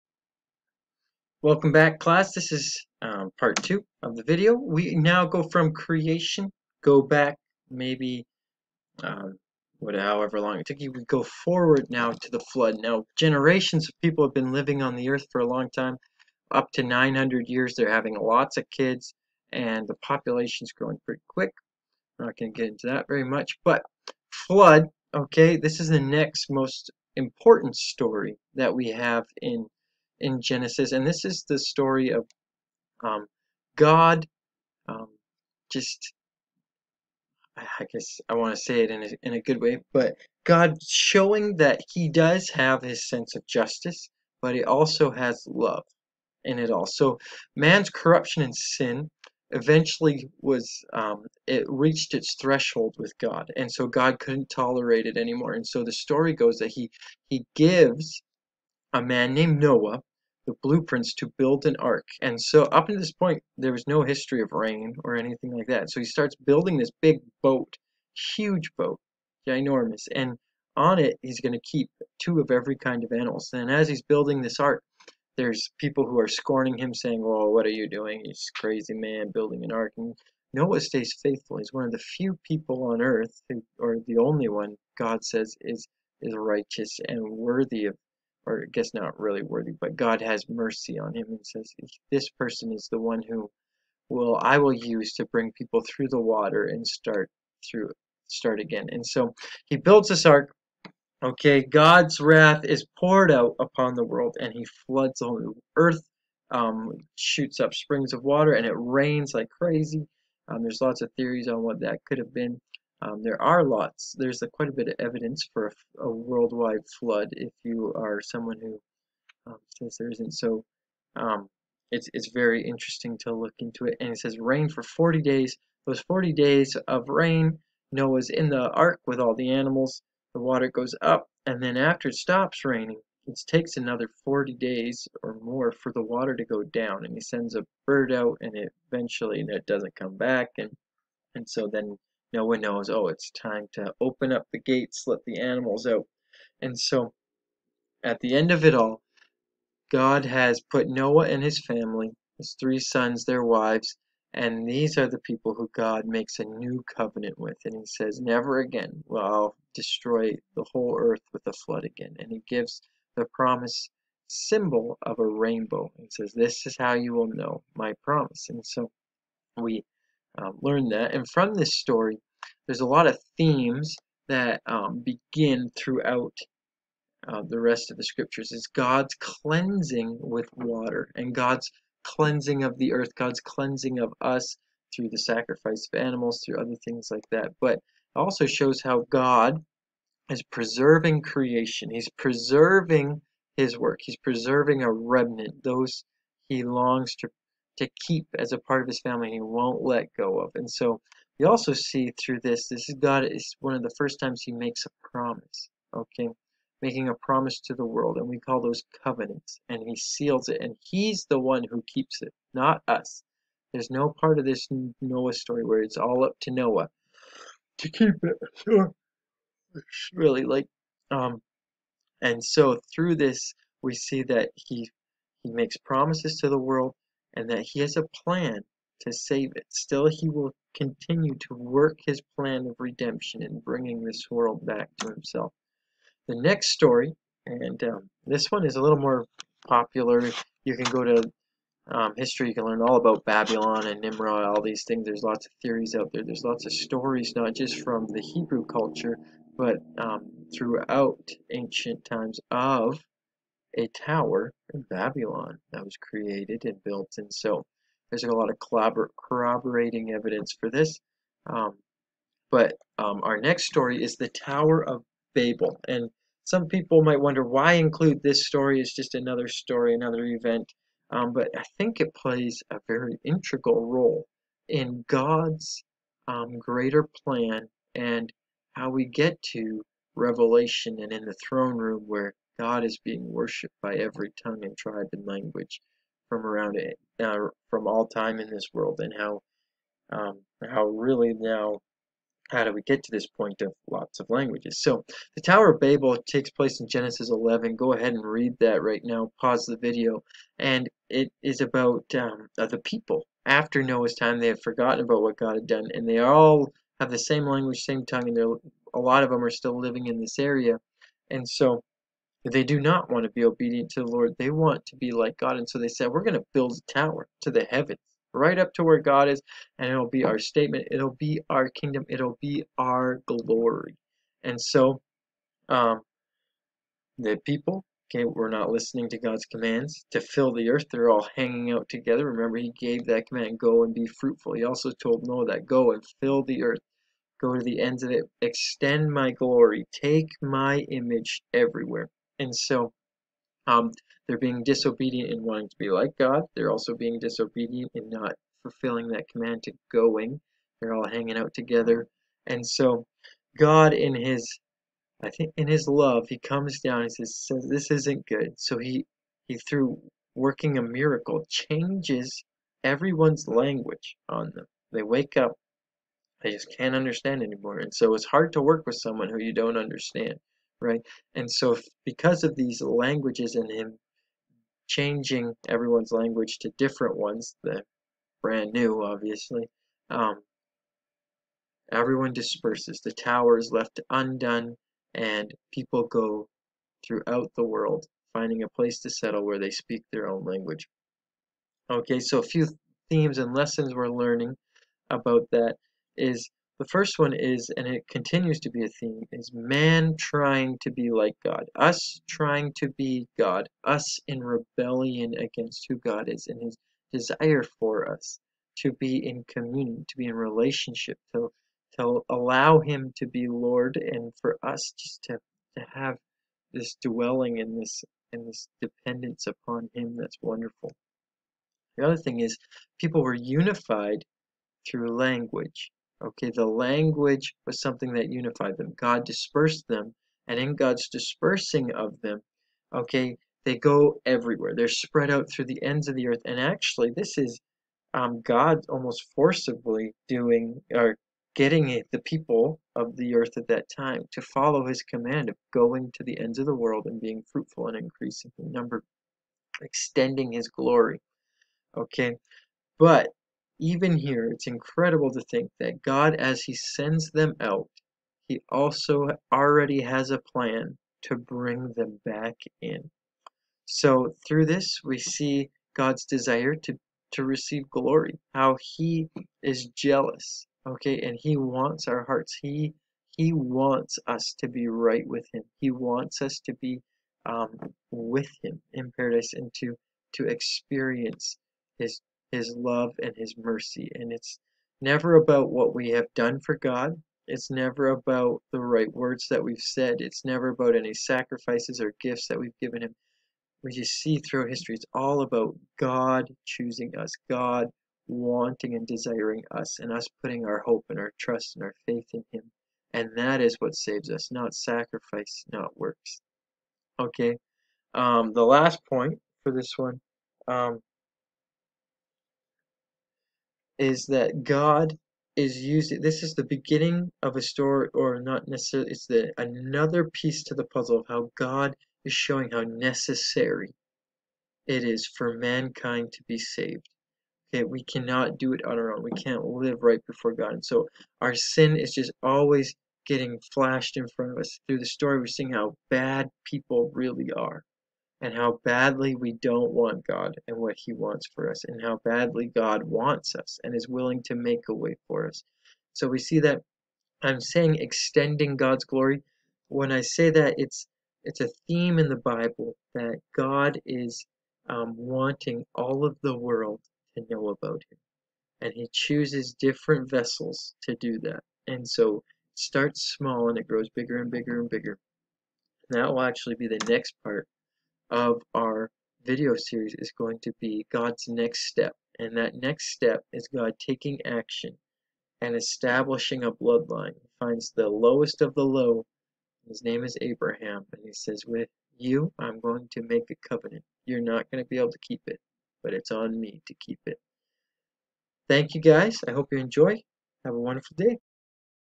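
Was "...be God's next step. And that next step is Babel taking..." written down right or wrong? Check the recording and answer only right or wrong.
wrong.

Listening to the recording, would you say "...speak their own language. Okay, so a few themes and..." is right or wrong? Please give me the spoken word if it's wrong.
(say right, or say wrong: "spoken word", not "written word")
right.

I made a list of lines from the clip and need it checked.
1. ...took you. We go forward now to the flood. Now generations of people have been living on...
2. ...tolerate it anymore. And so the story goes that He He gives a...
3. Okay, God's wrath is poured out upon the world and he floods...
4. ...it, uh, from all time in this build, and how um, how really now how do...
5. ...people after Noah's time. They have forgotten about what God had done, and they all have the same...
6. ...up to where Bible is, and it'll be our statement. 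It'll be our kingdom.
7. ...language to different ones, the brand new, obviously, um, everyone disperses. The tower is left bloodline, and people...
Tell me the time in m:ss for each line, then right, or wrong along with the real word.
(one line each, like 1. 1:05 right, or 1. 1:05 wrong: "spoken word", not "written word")
1. 0:10 right
2. 0:54 right
3. 1:41 right
4. 4:46 wrong: "world", not "build"
5. 5:02 right
6. 5:18 wrong: "God", not "Bible"
7. 6:16 wrong: "undone", not "bloodline".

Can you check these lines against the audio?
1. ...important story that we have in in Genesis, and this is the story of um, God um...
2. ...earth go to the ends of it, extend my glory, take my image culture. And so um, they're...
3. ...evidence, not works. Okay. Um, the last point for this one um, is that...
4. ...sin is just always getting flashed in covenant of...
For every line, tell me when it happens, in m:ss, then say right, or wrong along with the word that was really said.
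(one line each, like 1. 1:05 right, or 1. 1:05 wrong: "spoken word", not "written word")
1. 0:27 right
2. 5:36 wrong: "everywhere", not "culture"
3. 8:24 wrong: "sacrifice", not "evidence"
4. 8:51 wrong: "front", not "covenant".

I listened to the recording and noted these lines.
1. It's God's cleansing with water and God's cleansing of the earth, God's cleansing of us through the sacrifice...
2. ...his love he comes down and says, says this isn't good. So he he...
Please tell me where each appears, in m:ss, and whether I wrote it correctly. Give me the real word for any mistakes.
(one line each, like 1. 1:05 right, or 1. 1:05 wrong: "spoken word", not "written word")
1. 2:58 right
2. 5:55 right.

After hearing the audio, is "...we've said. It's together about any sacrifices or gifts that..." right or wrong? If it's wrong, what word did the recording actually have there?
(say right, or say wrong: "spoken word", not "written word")
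wrong: "never", not "together".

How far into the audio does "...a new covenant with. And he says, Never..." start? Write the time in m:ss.
2:36.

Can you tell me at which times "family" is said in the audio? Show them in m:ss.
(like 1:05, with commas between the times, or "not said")
2:31, 3:19.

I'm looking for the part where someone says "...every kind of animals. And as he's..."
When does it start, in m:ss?
1:12.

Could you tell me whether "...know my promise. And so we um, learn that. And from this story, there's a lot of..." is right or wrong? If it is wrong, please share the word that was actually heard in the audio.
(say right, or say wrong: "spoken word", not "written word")
right.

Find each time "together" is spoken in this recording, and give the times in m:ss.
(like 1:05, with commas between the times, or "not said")
5:31, 5:51.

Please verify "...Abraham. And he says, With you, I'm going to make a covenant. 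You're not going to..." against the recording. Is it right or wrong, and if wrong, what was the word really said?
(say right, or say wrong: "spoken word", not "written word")
right.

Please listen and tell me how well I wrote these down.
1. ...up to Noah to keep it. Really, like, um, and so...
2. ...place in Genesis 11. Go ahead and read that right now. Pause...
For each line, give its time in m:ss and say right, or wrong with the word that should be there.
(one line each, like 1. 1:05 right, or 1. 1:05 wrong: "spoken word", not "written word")
1. 3:36 right
2. 4:56 right.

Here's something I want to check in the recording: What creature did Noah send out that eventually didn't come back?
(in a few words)
A bird.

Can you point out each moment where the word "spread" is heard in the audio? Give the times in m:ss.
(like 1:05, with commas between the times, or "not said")
7:14.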